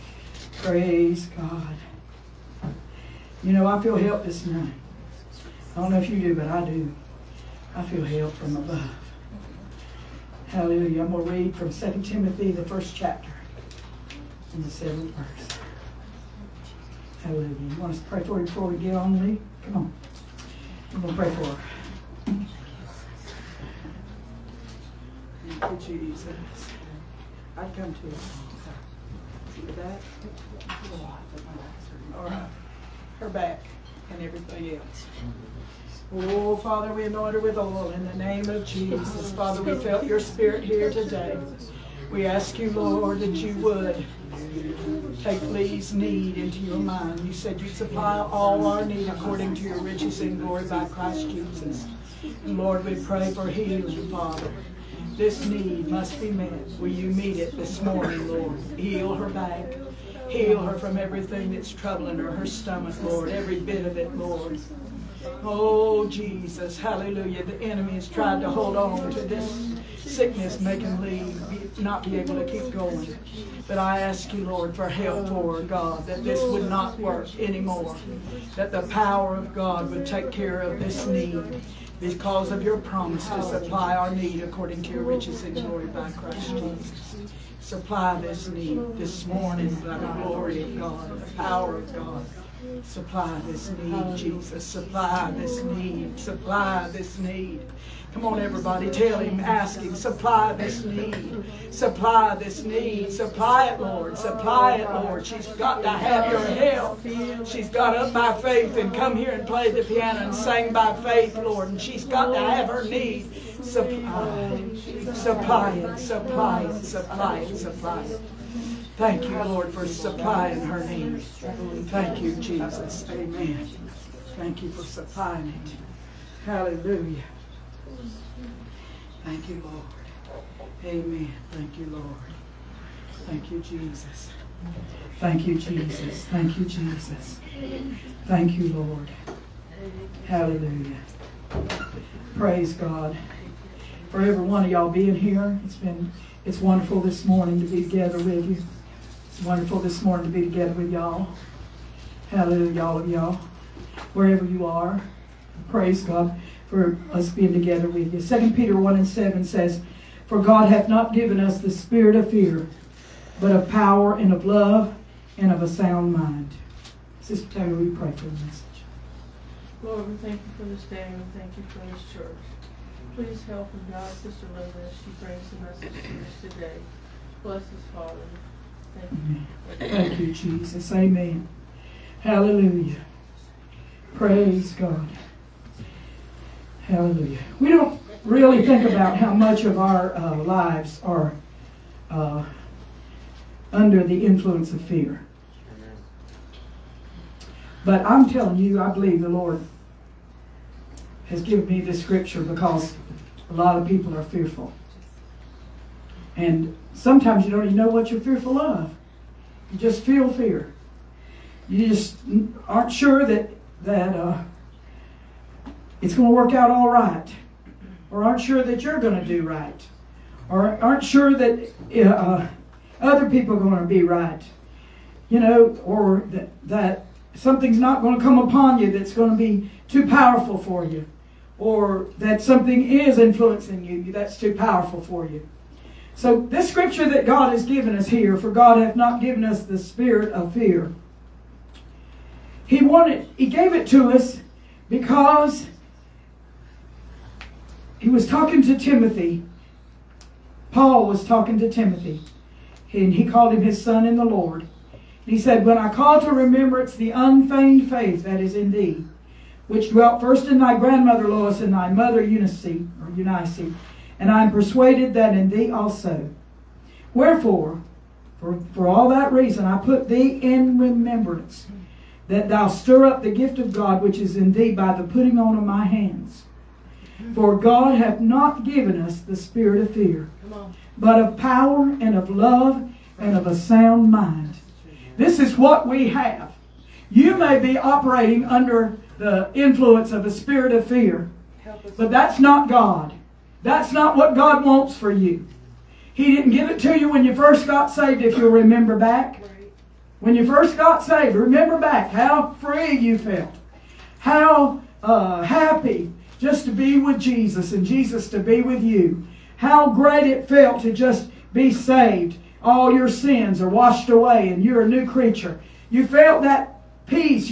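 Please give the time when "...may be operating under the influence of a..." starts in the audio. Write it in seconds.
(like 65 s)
287 s.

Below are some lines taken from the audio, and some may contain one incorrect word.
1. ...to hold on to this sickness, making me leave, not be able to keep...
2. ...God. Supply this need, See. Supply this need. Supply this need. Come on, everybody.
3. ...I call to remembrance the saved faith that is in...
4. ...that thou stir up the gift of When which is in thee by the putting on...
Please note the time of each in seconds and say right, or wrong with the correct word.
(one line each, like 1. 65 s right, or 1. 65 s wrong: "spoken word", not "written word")
1. 68 s right
2. 91 s wrong: "Jesus", not "See"
3. 255 s wrong: "unfeigned", not "saved"
4. 272 s wrong: "God", not "When".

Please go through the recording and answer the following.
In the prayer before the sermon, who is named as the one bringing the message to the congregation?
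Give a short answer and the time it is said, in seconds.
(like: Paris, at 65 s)
Sister Linda, at 174 s.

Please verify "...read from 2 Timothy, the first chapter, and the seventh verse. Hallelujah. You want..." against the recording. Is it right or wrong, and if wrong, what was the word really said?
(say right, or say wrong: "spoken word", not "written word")
right.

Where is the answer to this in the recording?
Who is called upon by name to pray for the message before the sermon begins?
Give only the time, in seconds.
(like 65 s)
167 s.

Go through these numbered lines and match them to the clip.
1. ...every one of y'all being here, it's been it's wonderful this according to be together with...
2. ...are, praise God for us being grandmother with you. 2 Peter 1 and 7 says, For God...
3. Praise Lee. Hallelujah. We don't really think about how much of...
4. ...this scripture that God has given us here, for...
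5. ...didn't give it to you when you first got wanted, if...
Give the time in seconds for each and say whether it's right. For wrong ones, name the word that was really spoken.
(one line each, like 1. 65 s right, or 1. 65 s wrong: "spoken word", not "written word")
1. 144 s wrong: "morning", not "according"
2. 154 s wrong: "together", not "grandmother"
3. 184 s wrong: "God", not "Lee"
4. 236 s right
5. 296 s wrong: "saved", not "wanted".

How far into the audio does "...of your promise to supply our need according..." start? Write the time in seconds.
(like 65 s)
82 s.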